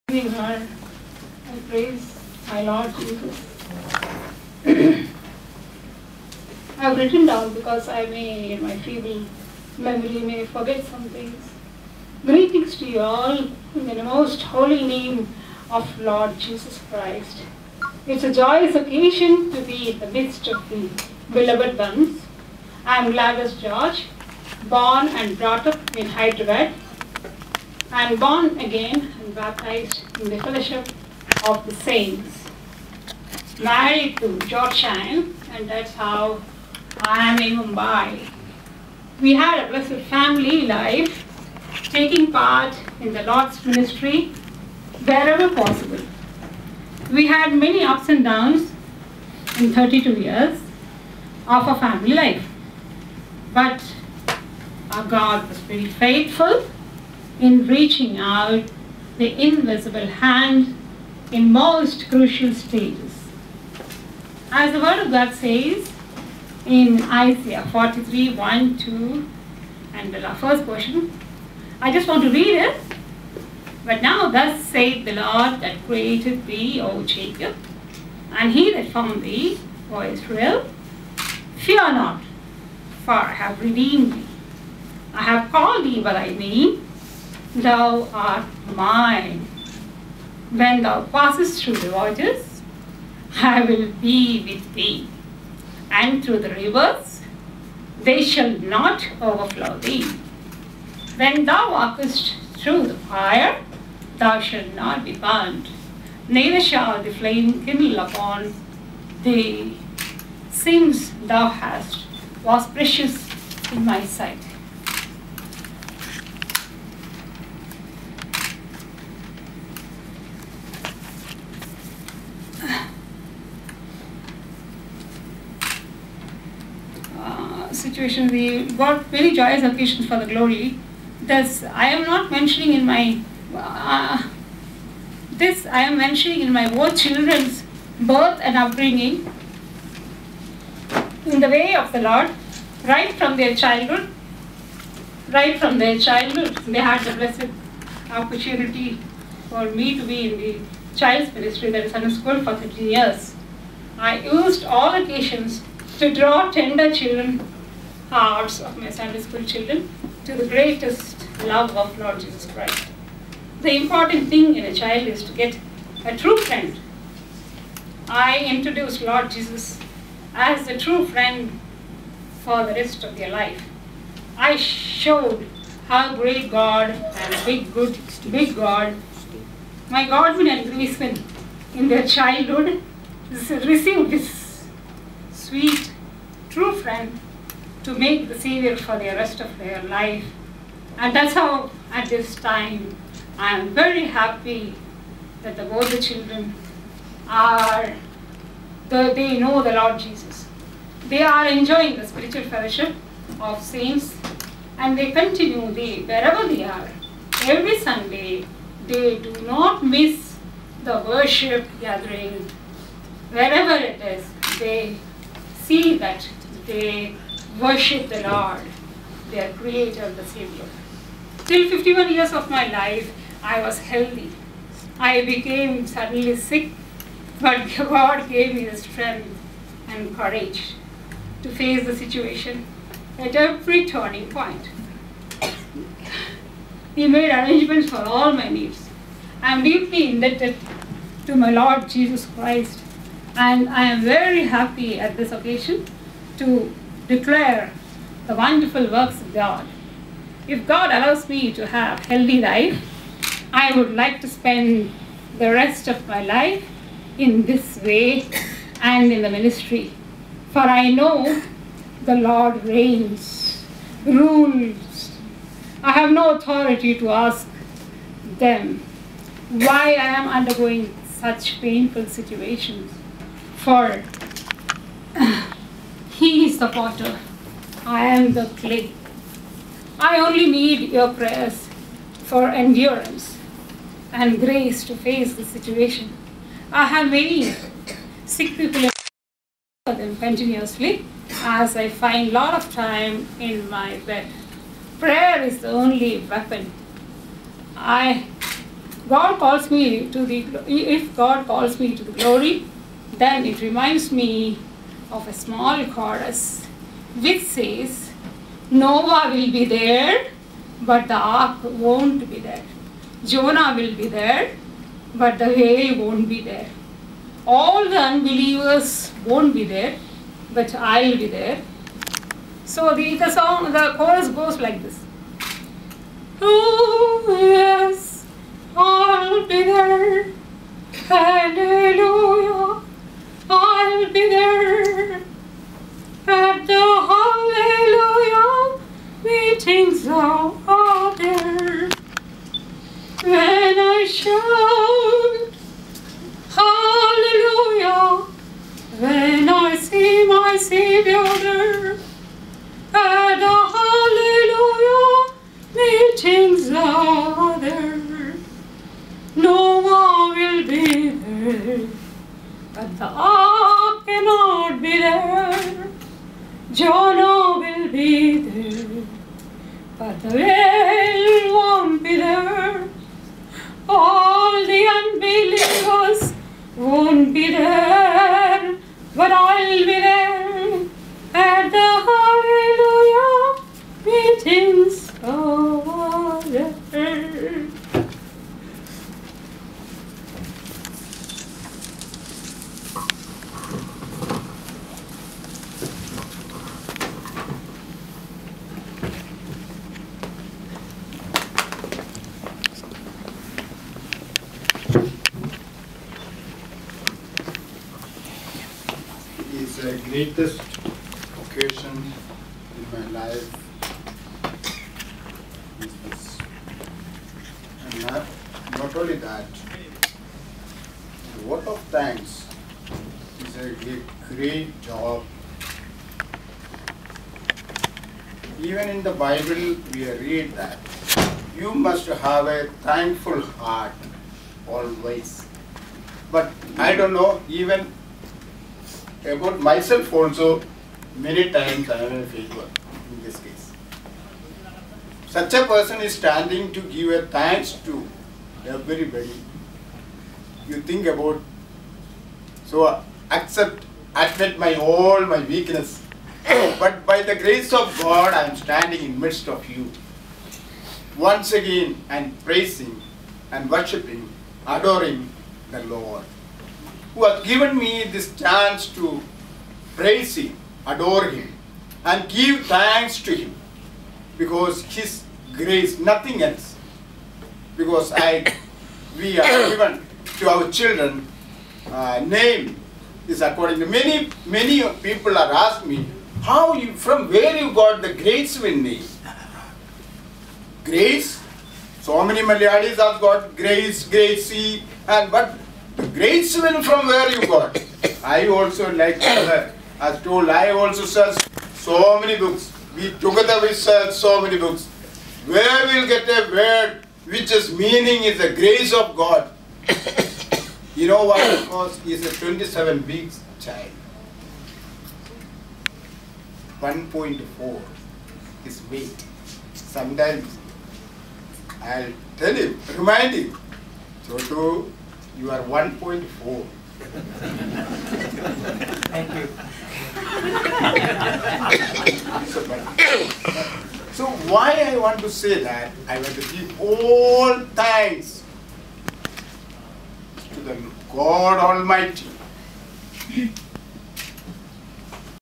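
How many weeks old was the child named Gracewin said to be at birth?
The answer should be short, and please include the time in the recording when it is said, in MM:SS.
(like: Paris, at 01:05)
27, at 08:32.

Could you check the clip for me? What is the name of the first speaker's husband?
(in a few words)
George Shine.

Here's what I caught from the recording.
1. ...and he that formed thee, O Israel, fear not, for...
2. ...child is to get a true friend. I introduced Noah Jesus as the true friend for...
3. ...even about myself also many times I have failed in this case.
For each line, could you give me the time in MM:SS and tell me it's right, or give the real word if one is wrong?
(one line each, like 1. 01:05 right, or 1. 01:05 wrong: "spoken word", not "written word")
1. 01:18 right
2. 02:44 wrong: "Lord", not "Noah"
3. 07:17 right.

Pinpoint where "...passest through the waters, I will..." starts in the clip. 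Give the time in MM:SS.
01:31.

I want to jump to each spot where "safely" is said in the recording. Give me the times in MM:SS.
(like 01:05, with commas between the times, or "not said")
not said.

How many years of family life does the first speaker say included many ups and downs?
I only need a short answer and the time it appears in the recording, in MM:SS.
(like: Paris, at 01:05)
32, at 00:49.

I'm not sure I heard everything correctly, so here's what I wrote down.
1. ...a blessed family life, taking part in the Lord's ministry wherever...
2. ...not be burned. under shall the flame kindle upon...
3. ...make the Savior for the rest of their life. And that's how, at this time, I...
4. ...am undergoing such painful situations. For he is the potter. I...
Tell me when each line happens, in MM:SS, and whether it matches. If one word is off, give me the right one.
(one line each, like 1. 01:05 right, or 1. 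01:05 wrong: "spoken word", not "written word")
1. 00:39 right
2. 01:44 wrong: "neither", not "under"
3. 03:07 right
4. 04:30 right.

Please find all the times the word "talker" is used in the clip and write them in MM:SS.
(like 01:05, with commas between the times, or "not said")
not said.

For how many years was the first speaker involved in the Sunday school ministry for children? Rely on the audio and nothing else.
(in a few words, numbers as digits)
13.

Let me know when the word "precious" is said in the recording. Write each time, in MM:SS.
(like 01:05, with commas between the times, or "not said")
01:52.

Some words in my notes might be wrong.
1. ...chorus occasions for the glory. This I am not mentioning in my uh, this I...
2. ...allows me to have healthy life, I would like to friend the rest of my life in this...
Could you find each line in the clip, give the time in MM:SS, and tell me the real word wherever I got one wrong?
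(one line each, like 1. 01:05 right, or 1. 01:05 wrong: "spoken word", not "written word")
1. 02:09 wrong: "joyous", not "chorus"
2. 04:10 wrong: "spend", not "friend".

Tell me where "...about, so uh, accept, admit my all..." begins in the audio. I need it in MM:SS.
07:31.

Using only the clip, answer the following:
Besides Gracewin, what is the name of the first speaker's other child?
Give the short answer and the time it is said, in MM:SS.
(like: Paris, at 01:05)
Godwin, at 03:00.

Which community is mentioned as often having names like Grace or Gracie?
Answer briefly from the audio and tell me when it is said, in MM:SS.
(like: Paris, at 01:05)
Malayalis, at 08:12.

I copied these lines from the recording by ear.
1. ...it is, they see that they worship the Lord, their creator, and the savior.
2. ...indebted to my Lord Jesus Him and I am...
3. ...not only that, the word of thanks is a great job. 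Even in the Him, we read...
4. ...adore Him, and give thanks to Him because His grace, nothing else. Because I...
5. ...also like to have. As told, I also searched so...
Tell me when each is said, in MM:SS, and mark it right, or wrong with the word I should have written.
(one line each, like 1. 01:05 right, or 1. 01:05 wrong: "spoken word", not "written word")
1. 03:33 right
2. 04:00 wrong: "Christ", not "Him"
3. 06:58 wrong: "Bible", not "Him"
4. 07:50 right
5. 08:18 right.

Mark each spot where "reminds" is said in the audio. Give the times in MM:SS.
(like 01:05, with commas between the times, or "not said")
05:03, 08:42.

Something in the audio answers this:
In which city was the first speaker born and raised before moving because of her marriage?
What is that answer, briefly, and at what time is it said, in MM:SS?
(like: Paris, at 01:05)
Hyderabad, at 00:26.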